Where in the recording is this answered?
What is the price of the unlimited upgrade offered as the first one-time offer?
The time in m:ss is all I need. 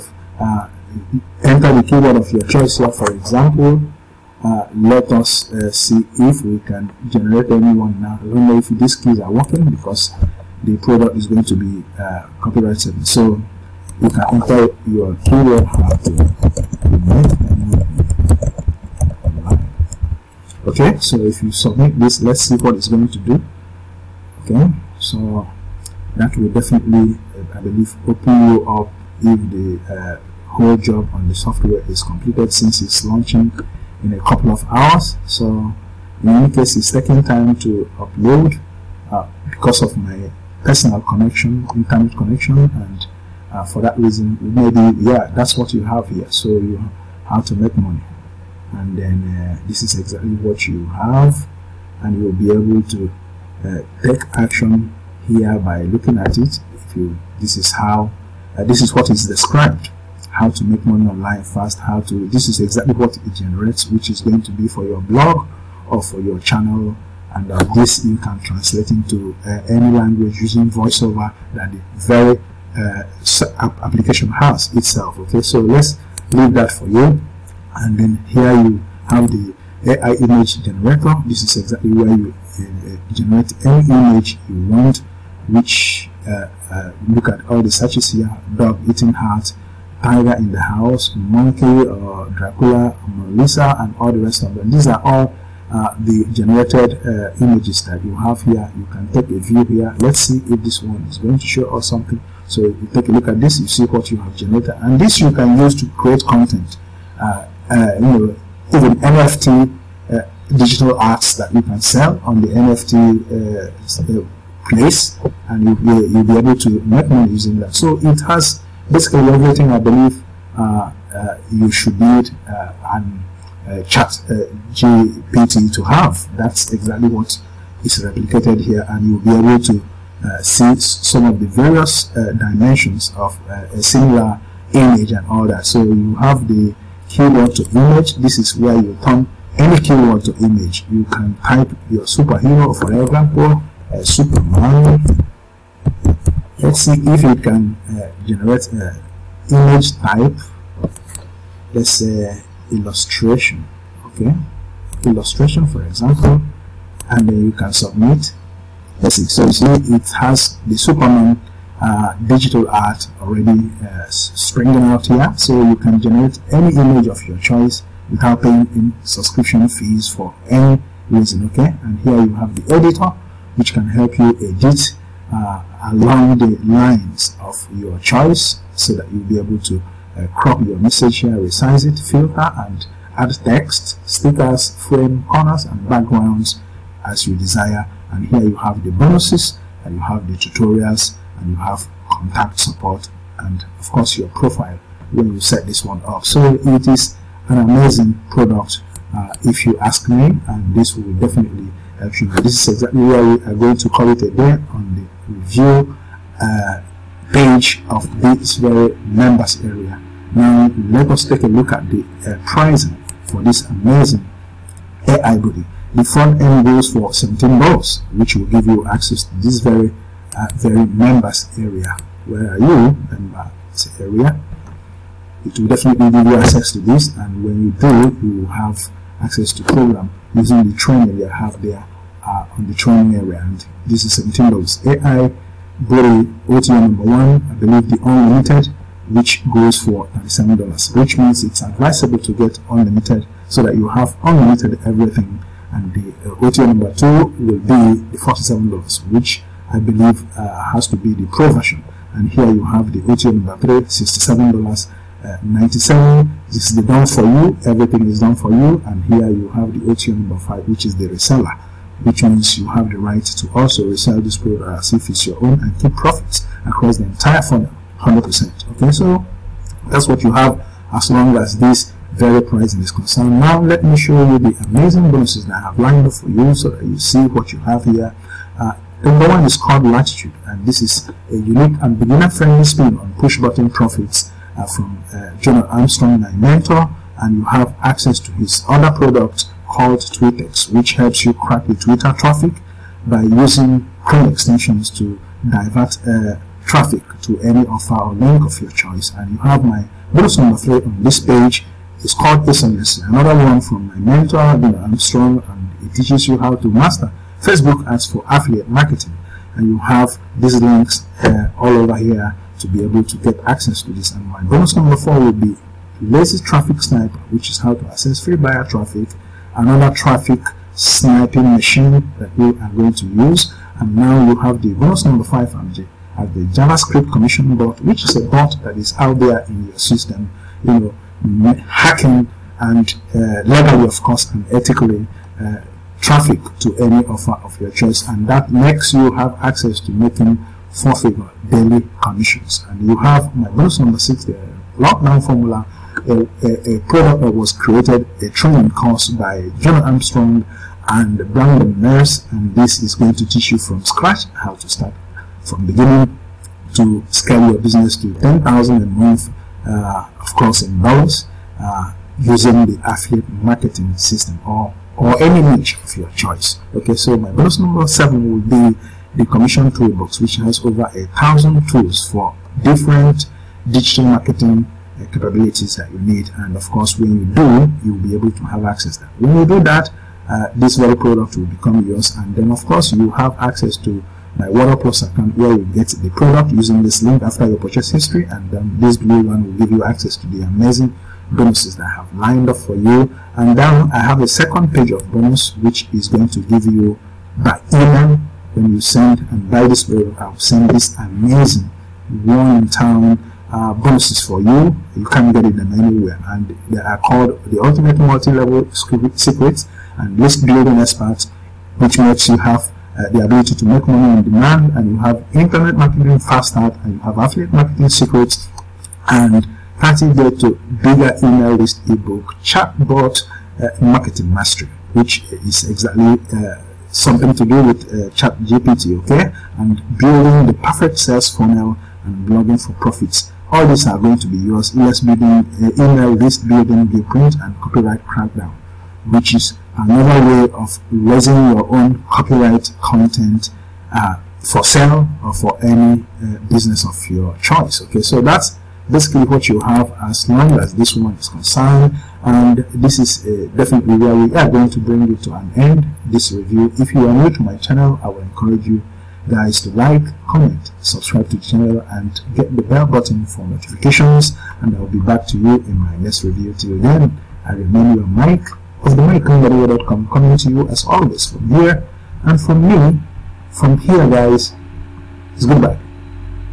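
4:00.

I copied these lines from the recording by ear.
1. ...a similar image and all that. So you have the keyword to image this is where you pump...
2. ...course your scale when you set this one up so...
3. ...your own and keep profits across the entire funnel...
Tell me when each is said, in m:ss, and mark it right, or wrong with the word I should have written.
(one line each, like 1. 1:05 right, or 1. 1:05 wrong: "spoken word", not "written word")
1. 2:13 right
2. 3:13 wrong: "profile", not "scale"
3. 4:25 right.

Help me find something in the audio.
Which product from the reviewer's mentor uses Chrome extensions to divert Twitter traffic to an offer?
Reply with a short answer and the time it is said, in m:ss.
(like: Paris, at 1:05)
Twitex, at 4:50.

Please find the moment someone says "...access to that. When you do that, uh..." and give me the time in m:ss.
6:18.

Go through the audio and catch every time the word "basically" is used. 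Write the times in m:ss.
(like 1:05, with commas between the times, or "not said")
1:58, 7:28.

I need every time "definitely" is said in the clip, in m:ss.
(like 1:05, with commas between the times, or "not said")
0:26, 3:21, 3:45, 7:33.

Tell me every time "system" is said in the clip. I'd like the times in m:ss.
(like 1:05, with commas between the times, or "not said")
5:29, 6:03.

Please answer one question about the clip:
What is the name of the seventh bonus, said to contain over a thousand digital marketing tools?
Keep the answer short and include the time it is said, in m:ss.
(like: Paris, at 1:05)
Commission Toolbox, at 6:09.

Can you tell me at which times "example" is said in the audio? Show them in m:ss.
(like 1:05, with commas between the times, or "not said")
0:03, 2:23, 2:35.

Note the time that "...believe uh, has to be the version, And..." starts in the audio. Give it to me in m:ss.
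4:09.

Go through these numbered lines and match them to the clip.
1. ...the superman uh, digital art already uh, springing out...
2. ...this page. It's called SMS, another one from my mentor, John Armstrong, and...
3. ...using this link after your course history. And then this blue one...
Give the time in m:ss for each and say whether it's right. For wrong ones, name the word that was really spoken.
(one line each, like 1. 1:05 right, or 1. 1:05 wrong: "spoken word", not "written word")
1. 2:40 right
2. 5:01 right
3. 6:26 wrong: "purchase", not "course".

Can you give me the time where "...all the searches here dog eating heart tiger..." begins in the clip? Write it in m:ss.
1:27.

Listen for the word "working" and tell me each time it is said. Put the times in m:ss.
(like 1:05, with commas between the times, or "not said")
0:09.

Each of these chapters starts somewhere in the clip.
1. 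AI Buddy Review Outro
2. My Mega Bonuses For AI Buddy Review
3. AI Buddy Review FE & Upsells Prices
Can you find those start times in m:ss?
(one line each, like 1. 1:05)
1. 7:34
2. 4:37
3. 3:32.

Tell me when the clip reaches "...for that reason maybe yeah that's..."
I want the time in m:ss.
0:43.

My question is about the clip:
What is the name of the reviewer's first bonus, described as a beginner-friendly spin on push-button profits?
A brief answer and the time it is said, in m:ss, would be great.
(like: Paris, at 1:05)
Latitude, at 4:39.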